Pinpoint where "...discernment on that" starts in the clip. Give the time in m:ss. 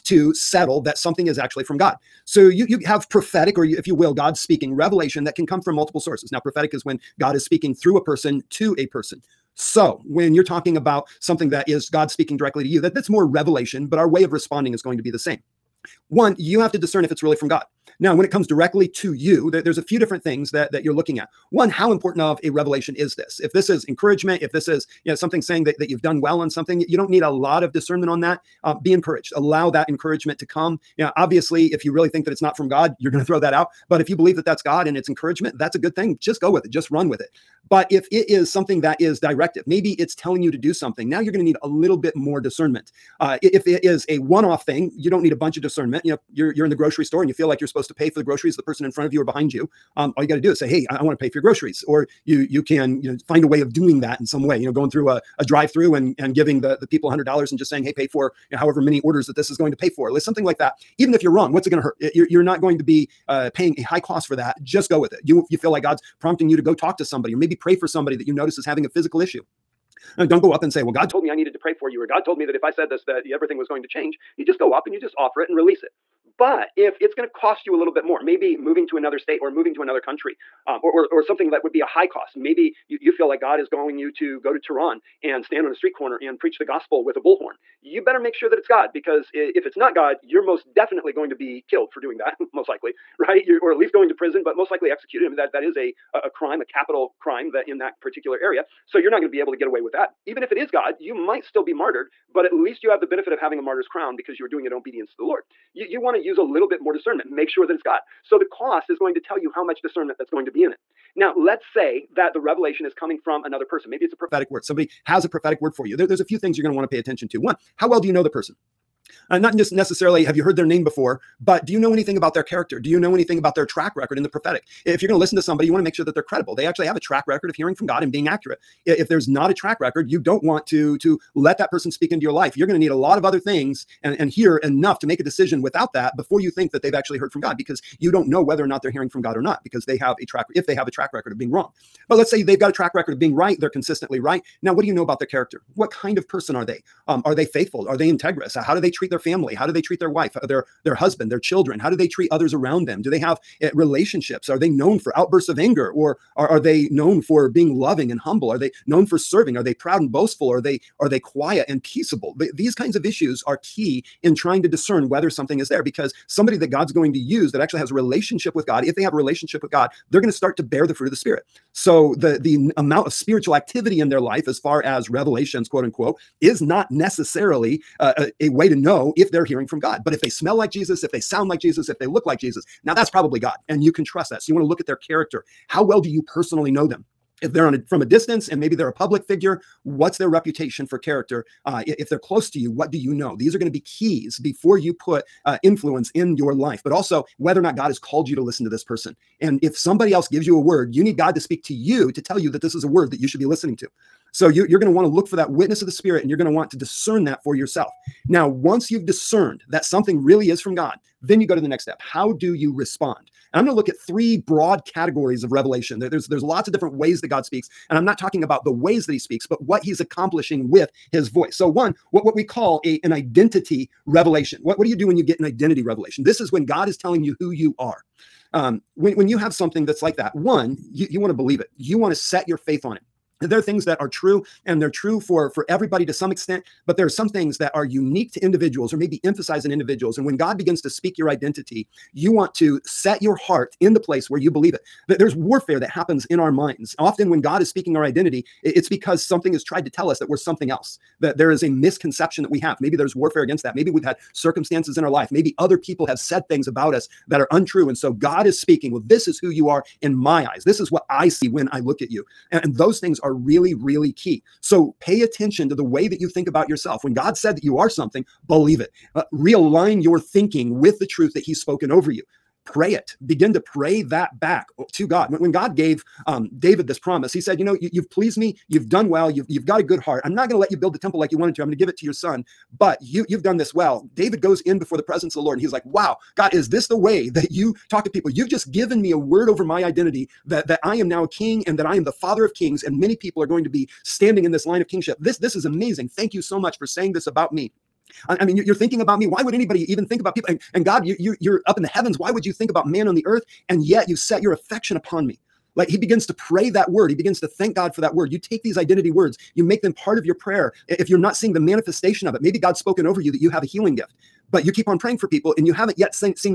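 0:27.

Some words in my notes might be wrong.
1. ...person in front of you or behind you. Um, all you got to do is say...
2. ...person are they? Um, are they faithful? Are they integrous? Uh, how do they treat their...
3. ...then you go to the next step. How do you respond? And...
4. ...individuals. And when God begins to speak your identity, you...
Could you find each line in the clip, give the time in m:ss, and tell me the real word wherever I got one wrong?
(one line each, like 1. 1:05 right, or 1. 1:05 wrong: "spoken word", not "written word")
1. 0:48 right
2. 2:26 right
3. 3:31 right
4. 3:59 right.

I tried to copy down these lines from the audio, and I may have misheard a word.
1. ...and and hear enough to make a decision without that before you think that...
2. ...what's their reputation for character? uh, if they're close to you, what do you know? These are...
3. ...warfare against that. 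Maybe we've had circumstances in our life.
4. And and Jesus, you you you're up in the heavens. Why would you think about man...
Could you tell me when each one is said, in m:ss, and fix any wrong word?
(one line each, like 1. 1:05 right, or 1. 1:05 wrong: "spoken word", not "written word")
1. 2:14 right
2. 3:09 right
3. 4:13 right
4. 5:00 wrong: "God", not "Jesus".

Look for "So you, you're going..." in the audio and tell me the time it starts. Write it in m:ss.
3:24.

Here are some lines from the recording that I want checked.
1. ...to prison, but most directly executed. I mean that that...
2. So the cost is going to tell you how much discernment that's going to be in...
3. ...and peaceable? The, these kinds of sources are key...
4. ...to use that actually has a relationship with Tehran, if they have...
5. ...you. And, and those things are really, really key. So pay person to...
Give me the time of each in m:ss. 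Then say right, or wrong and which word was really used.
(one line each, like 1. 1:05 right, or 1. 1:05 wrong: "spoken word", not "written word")
1. 1:34 wrong: "likely", not "directly"
2. 1:48 right
3. 2:41 wrong: "issues", not "sources"
4. 2:47 wrong: "God", not "Tehran"
5. 4:22 wrong: "attention", not "person".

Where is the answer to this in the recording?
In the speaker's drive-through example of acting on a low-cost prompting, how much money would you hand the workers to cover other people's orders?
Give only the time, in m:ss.
0:57.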